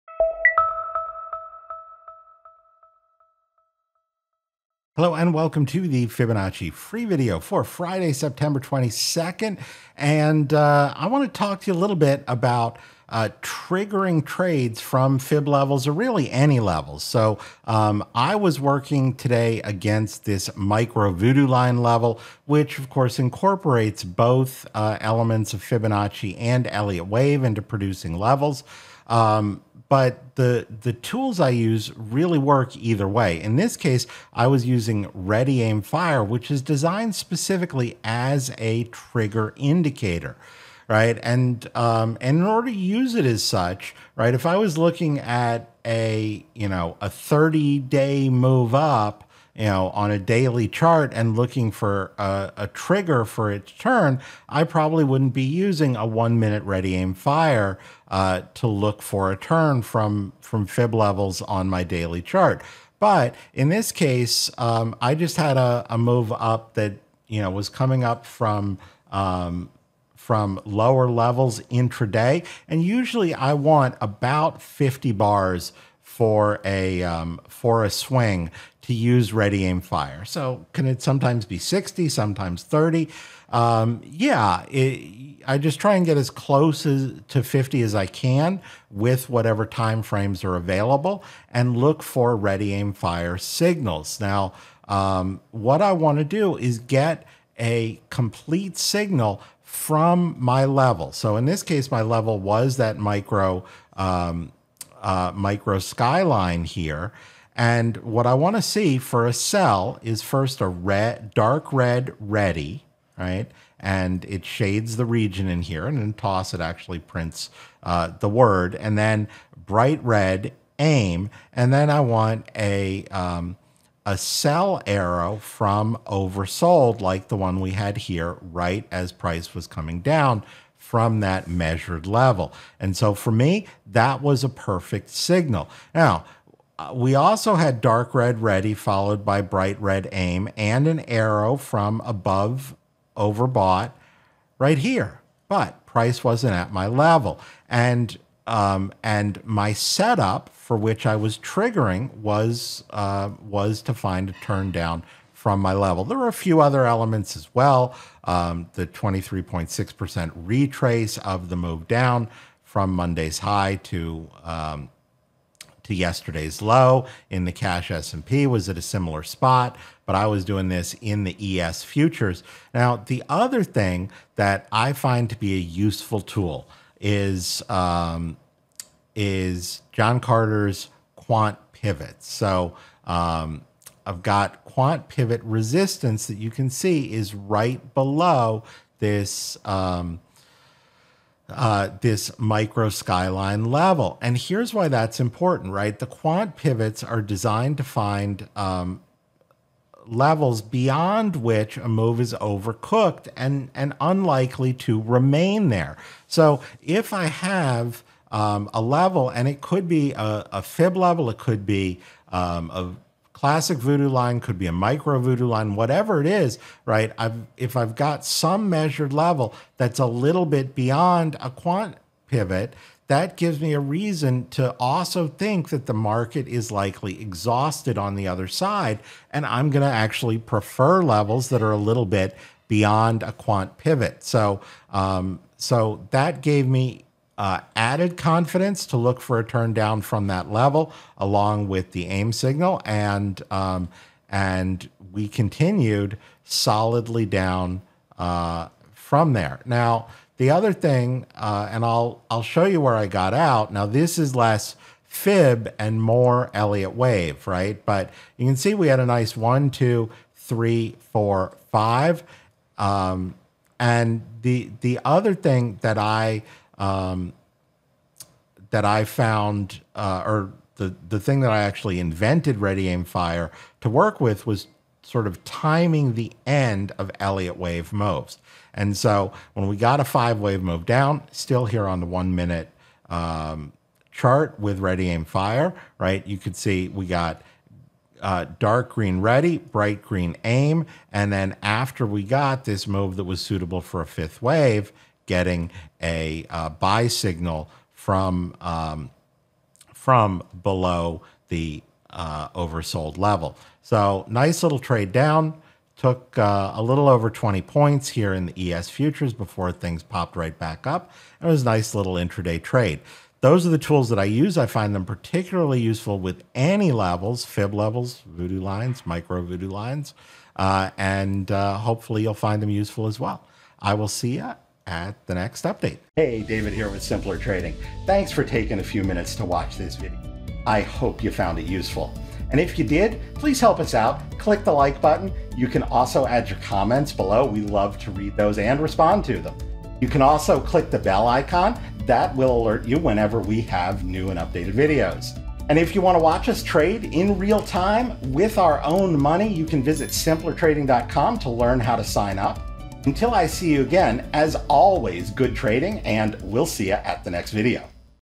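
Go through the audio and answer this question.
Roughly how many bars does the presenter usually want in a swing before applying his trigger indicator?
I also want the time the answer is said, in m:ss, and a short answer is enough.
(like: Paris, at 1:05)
50, at 1:14.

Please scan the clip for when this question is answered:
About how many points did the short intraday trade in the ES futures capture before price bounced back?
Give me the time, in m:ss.
5:07.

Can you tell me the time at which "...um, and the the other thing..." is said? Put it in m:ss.
4:22.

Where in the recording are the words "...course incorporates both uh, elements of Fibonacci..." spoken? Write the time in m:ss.
0:22.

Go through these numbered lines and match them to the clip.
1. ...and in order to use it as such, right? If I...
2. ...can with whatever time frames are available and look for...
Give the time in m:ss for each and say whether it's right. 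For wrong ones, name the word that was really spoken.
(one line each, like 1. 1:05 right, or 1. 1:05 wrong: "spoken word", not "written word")
1. 0:42 right
2. 1:28 right.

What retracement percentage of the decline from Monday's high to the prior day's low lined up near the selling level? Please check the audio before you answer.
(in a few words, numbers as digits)
23.6%.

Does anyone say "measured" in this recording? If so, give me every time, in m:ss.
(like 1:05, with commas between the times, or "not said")
2:11, 3:38.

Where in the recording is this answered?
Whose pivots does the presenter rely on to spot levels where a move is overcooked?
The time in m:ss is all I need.
2:59.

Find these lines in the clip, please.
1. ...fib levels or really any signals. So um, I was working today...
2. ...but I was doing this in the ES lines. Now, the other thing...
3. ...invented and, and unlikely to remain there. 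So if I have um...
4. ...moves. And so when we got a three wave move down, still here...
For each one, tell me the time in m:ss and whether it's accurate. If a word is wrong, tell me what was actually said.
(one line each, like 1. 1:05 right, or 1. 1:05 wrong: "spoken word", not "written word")
1. 0:15 wrong: "levels", not "signals"
2. 2:50 wrong: "futures", not "lines"
3. 3:22 wrong: "overcooked", not "invented"
4. 4:37 wrong: "five", not "three".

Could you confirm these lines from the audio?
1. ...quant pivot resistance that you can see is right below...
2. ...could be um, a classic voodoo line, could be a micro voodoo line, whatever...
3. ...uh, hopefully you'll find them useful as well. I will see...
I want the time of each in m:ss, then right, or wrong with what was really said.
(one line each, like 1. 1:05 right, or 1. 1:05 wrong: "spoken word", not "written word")
1. 3:04 right
2. 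3:31 right
3. 5:21 right.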